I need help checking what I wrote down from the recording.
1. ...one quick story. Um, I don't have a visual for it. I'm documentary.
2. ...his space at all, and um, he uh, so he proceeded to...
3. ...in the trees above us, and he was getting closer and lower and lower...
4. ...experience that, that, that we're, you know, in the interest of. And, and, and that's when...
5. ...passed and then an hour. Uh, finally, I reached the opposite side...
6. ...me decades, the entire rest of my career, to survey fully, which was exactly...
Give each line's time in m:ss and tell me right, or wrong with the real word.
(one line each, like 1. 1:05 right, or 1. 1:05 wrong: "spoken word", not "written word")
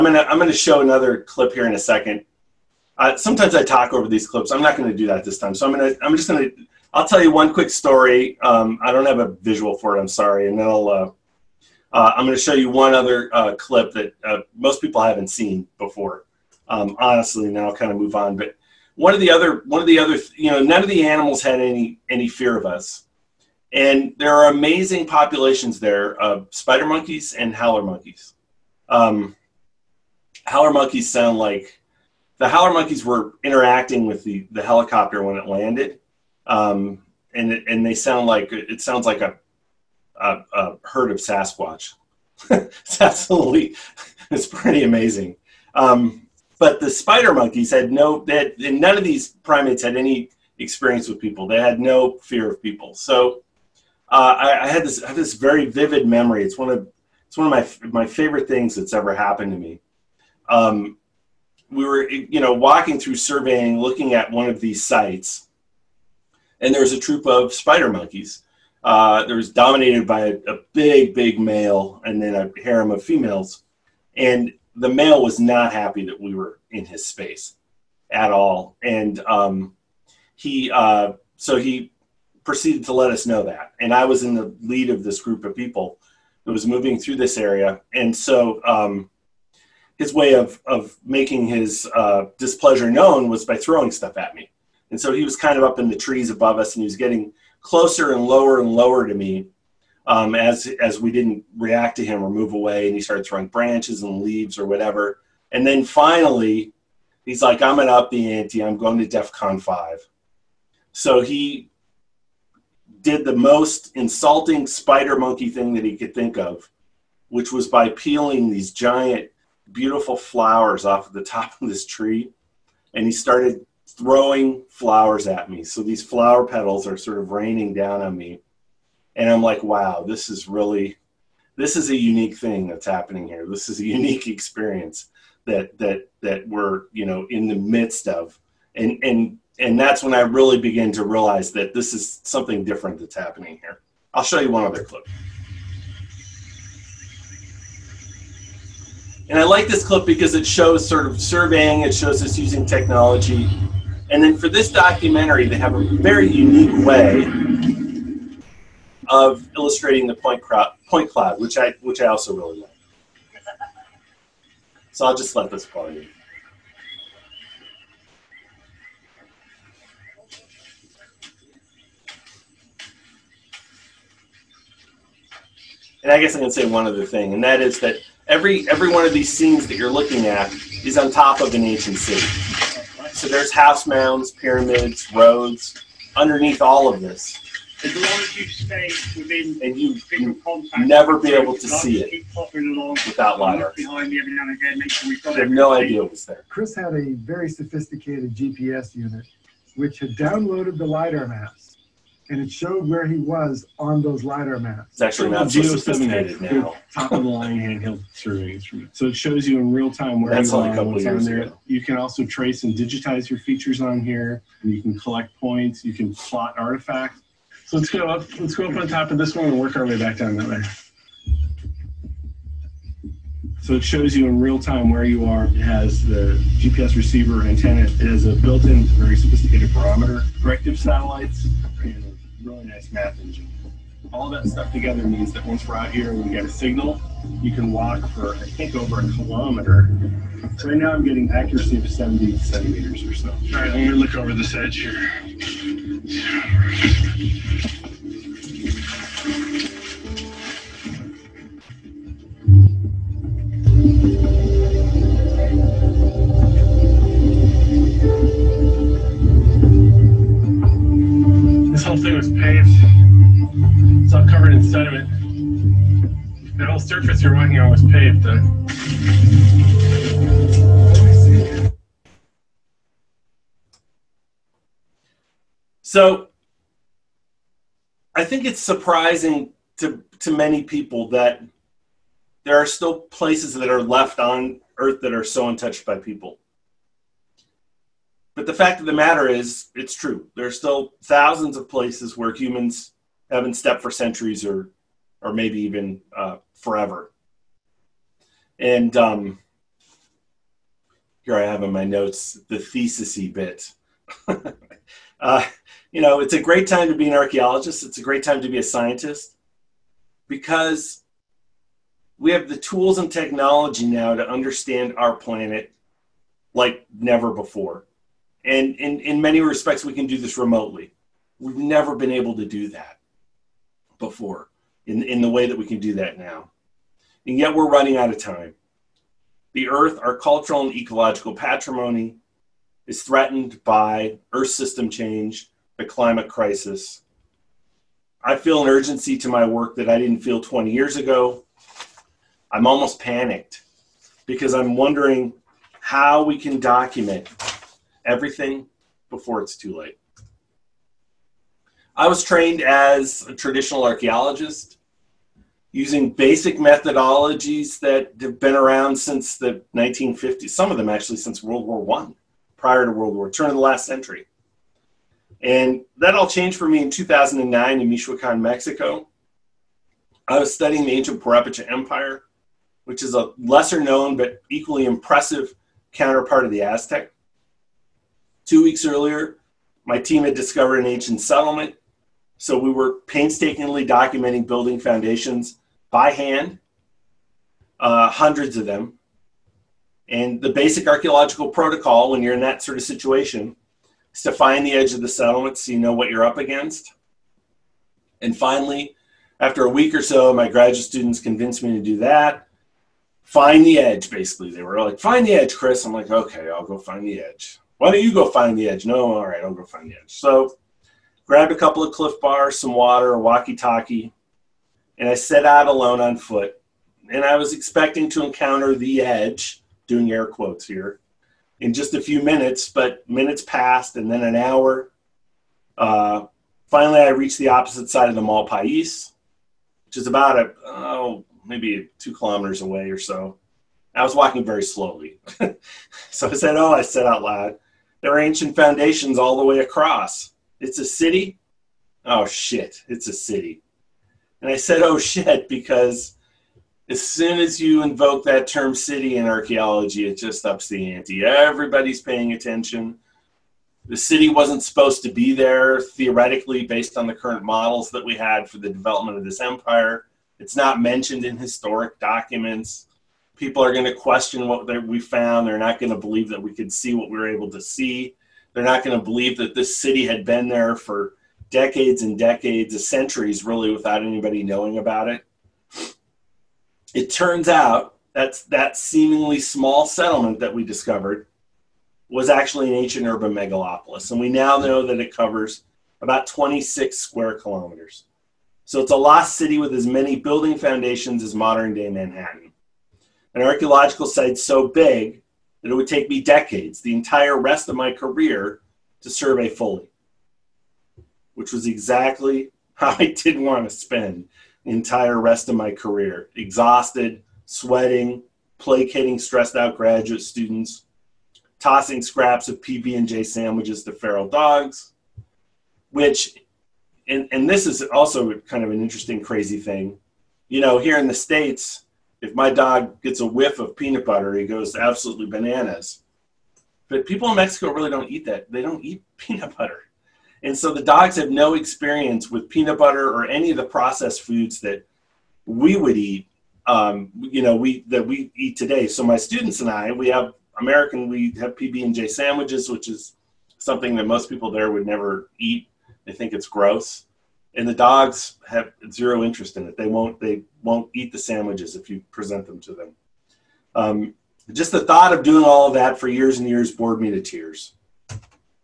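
1. 0:07 wrong: "sorry", not "documentary"
2. 1:16 right
3. 1:35 right
4. 2:14 wrong: "midst", not "interest"
5. 7:03 right
6. 8:16 right.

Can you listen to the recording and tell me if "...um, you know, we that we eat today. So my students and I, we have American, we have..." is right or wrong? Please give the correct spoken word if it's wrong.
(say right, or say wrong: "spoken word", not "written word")
right.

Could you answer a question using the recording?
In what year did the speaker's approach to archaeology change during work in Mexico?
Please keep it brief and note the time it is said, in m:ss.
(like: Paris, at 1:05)
2009, at 6:06.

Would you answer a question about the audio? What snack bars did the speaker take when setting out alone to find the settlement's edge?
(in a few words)
Cliff bars.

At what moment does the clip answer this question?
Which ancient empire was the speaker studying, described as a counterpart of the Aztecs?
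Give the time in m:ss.
6:11.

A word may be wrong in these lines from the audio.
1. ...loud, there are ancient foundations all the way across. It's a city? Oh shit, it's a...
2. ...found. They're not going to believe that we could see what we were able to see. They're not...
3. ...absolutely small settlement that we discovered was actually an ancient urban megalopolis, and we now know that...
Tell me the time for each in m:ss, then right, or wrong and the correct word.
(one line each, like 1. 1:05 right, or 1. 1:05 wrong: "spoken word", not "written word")
1. 7:17 right
2. 7:44 right
3. 7:58 wrong: "seemingly", not "absolutely".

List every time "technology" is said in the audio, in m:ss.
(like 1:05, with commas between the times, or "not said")
2:32, 5:13.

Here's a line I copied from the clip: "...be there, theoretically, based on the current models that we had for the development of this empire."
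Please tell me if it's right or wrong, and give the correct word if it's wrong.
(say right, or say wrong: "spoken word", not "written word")
right.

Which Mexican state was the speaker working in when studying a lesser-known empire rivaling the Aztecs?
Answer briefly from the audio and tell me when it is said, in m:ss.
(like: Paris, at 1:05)
Michoacan, at 6:07.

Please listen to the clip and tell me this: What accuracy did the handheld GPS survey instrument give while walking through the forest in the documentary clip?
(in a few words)
70 centimeters.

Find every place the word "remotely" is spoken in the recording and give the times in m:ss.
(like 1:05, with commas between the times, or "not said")
5:20.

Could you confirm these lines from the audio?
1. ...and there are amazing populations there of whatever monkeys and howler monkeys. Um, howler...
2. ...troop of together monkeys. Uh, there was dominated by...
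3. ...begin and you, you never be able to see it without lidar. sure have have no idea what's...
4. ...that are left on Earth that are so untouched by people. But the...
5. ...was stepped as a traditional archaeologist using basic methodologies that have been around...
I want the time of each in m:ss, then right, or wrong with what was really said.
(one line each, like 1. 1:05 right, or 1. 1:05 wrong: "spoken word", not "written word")
1. 0:23 wrong: "spider", not "whatever"
2. 1:06 wrong: "spider", not "together"
3. 3:09 wrong: "within", not "begin"
4. 4:43 right
5. 5:52 wrong: "trained", not "stepped".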